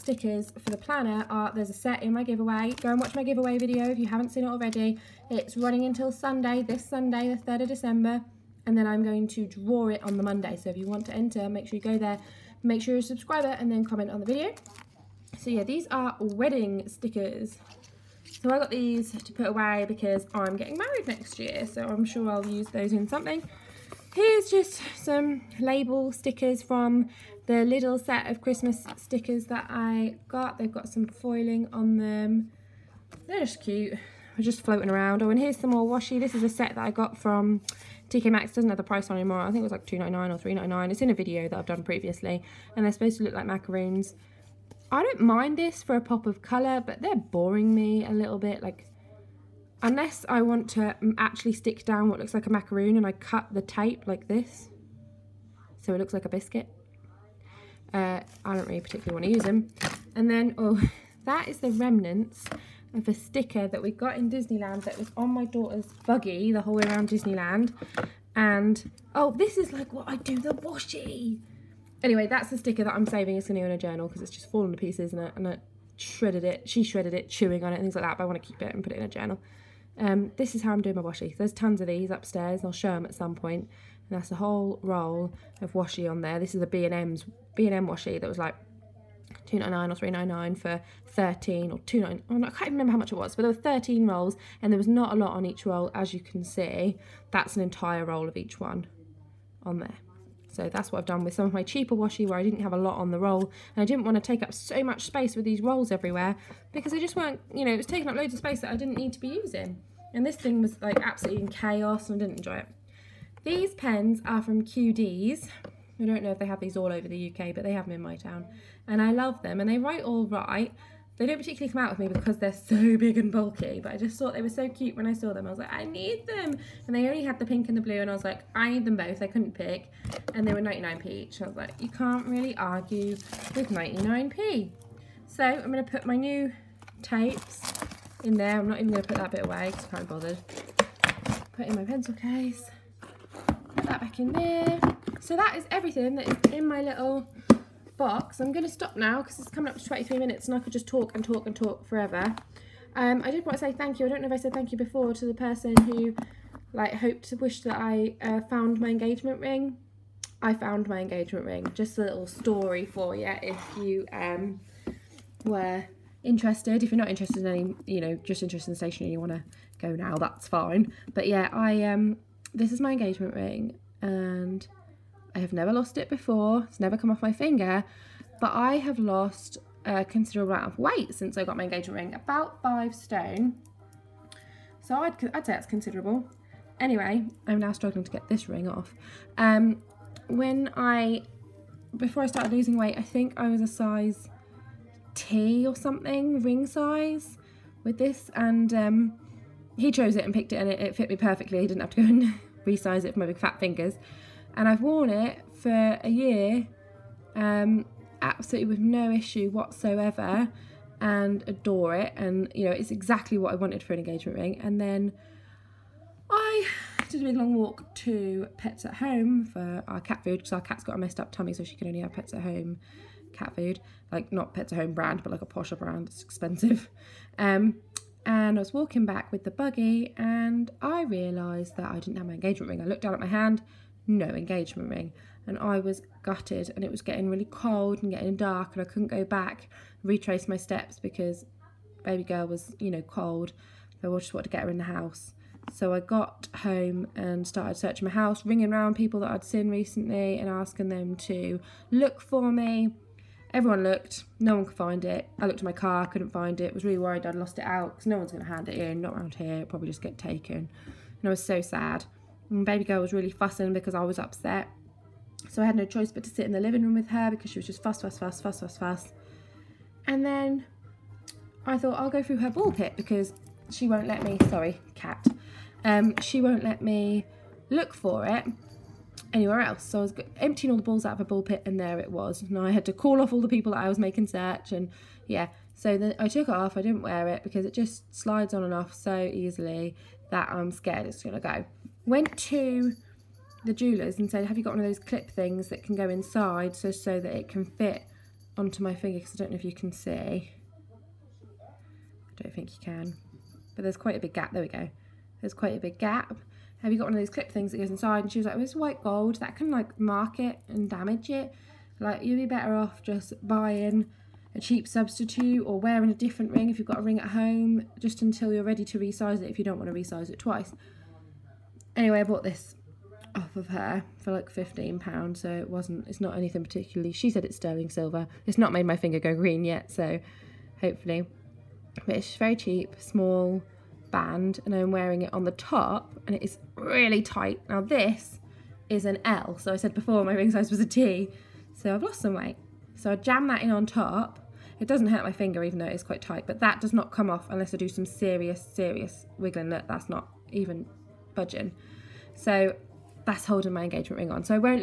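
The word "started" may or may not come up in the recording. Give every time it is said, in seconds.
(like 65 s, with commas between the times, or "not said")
192 s, 247 s.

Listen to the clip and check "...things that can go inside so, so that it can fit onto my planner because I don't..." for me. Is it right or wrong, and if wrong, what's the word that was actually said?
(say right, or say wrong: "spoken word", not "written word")
wrong: "finger", not "planner".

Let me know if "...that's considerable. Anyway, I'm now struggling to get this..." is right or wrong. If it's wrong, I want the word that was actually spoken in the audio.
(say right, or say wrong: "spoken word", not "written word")
right.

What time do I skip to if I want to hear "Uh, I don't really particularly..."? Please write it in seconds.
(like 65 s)
57 s.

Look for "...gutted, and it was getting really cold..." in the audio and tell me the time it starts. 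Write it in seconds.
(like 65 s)
236 s.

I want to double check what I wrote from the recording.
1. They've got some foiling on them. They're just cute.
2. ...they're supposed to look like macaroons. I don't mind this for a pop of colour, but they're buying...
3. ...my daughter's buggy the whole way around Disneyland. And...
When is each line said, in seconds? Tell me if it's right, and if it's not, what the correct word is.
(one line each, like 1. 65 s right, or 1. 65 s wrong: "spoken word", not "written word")
1. 30 s right
2. 42 s wrong: "boring", not "buying"
3. 65 s right.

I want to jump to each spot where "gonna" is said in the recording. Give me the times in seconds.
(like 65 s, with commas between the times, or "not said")
291 s.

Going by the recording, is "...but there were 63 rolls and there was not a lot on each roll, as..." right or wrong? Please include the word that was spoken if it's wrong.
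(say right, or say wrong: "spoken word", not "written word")
wrong: "13", not "63".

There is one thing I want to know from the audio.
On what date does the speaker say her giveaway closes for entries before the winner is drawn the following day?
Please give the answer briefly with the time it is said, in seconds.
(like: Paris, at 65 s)
3rd of December, at 7 s.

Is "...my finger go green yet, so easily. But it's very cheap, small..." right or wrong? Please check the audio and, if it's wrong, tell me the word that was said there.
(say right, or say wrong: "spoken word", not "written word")
wrong: "hopefully", not "easily".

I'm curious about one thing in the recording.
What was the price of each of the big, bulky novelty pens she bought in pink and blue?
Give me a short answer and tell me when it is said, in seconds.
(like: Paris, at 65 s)
99p, at 130 s.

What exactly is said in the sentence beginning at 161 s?
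Just a little story for you if you um, were interested.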